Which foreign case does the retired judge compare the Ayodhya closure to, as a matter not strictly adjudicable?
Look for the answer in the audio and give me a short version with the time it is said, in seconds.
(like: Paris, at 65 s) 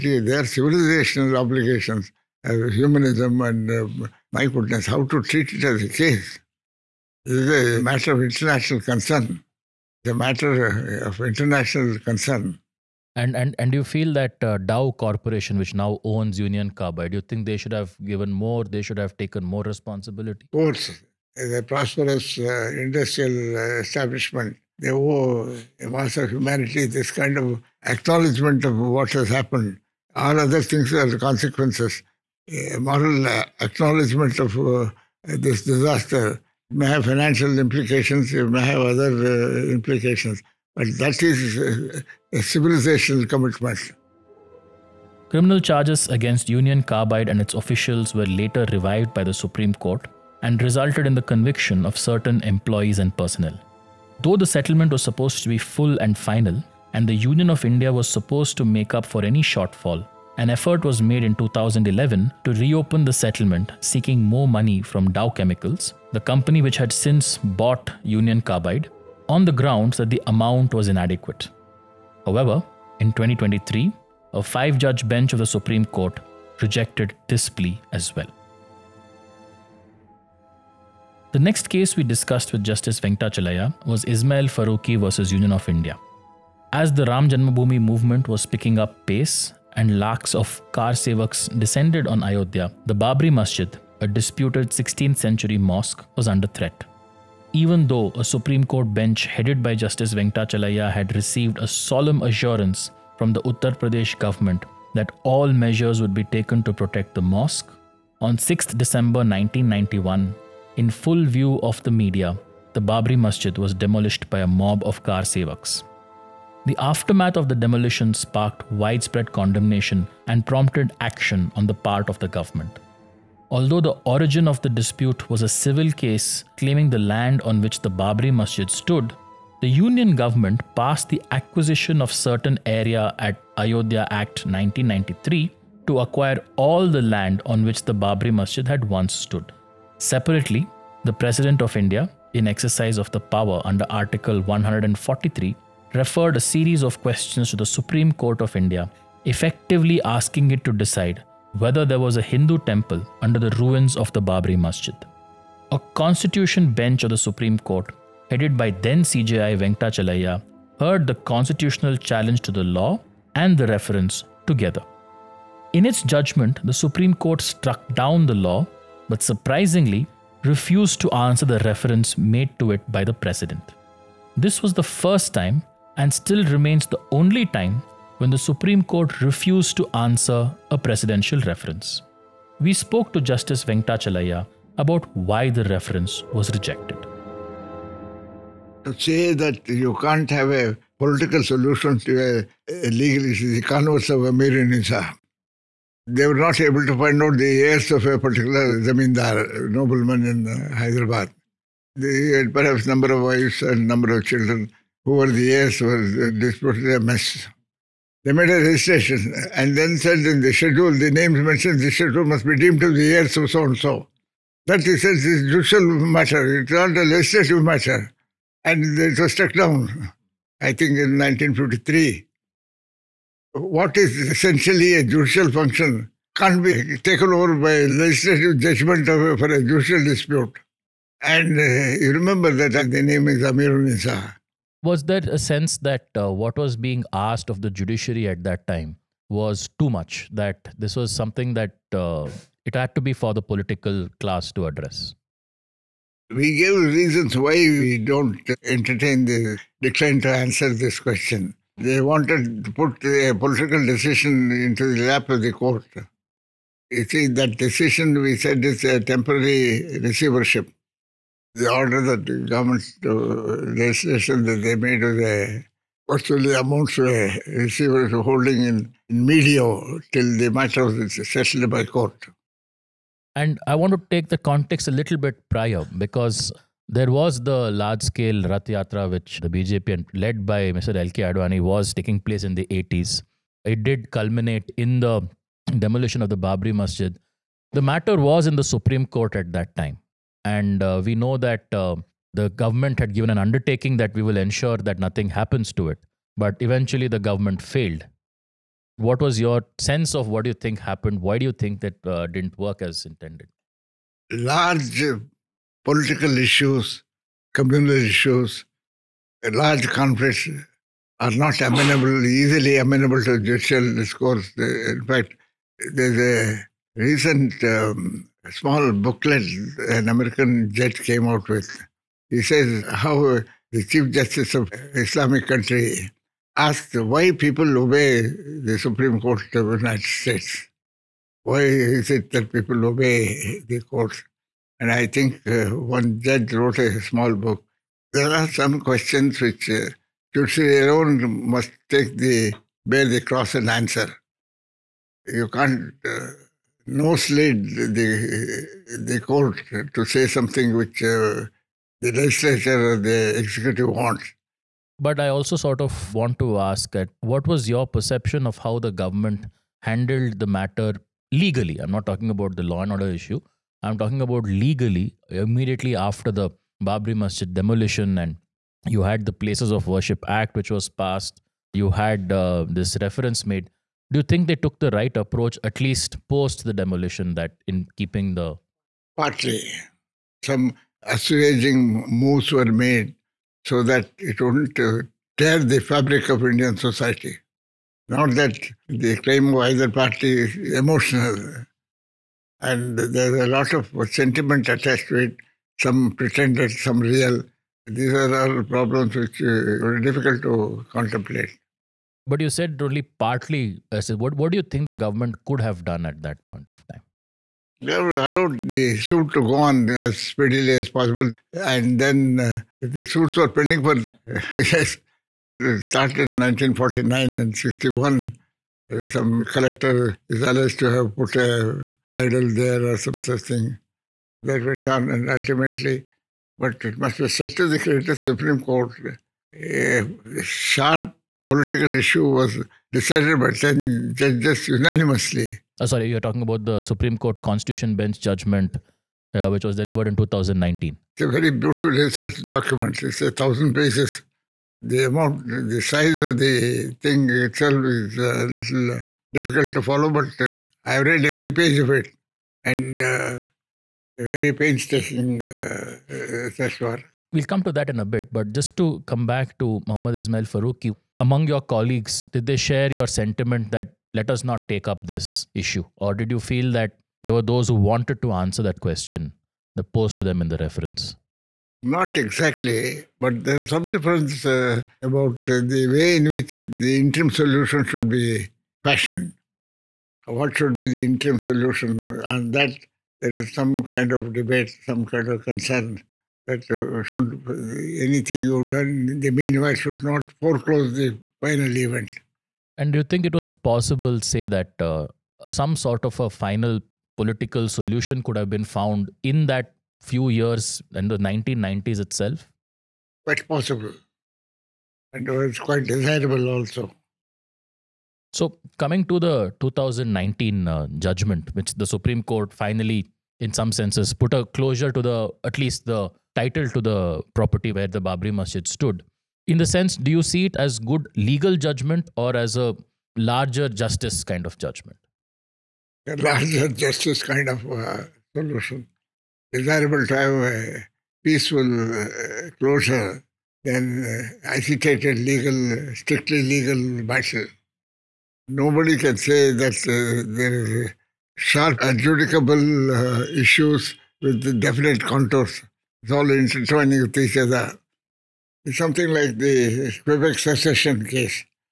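Quebec secession case, at 550 s.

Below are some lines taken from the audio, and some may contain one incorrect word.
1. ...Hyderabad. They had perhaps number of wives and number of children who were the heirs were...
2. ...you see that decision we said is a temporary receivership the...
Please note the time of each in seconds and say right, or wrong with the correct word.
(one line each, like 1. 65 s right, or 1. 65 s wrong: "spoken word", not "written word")
1. 200 s right
2. 256 s right.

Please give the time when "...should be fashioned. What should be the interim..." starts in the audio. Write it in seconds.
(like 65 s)
477 s.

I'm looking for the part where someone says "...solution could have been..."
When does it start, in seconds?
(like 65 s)
497 s.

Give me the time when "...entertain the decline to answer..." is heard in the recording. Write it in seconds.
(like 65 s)
248 s.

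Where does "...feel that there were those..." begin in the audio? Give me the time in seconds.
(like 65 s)
466 s.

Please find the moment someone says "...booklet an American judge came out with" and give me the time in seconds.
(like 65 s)
318 s.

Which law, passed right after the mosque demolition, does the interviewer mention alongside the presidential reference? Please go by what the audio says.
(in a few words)
Places of Worship Act.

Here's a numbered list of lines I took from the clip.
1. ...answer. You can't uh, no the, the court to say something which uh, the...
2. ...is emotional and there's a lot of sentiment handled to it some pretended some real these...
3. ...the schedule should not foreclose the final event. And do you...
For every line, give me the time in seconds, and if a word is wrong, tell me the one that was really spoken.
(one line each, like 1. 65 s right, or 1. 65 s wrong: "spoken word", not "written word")
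1. 343 s right
2. 390 s wrong: "attached", not "handled"
3. 489 s wrong: "meanwhile", not "schedule".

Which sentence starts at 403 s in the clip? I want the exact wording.
I said, what, what do you think the government could have done at that point of time?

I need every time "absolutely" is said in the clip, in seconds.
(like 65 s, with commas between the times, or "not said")
not said.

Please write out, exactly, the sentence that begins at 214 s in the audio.
That is he says judicial matter, it's not a legislative matter.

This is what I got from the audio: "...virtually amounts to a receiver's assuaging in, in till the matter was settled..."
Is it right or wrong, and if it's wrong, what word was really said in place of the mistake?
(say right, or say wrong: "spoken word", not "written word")
wrong: "holding", not "assuaging".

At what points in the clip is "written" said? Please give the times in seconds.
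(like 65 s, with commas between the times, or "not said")
not said.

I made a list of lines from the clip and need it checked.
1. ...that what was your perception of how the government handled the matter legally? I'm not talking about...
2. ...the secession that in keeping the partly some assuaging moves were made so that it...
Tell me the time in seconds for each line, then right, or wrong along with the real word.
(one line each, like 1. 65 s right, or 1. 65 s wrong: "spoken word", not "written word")
1. 356 s right
2. 376 s wrong: "demolition", not "secession".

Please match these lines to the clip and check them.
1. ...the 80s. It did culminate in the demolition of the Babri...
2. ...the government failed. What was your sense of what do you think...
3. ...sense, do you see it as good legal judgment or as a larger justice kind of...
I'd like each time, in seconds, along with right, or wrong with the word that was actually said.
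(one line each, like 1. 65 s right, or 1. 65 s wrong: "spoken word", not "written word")
1. 282 s right
2. 297 s right
3. 519 s right.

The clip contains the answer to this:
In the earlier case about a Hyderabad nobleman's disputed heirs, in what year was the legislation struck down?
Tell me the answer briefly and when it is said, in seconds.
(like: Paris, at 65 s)
1953, at 221 s.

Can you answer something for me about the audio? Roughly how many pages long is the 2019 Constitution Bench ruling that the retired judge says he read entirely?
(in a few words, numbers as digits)
1000.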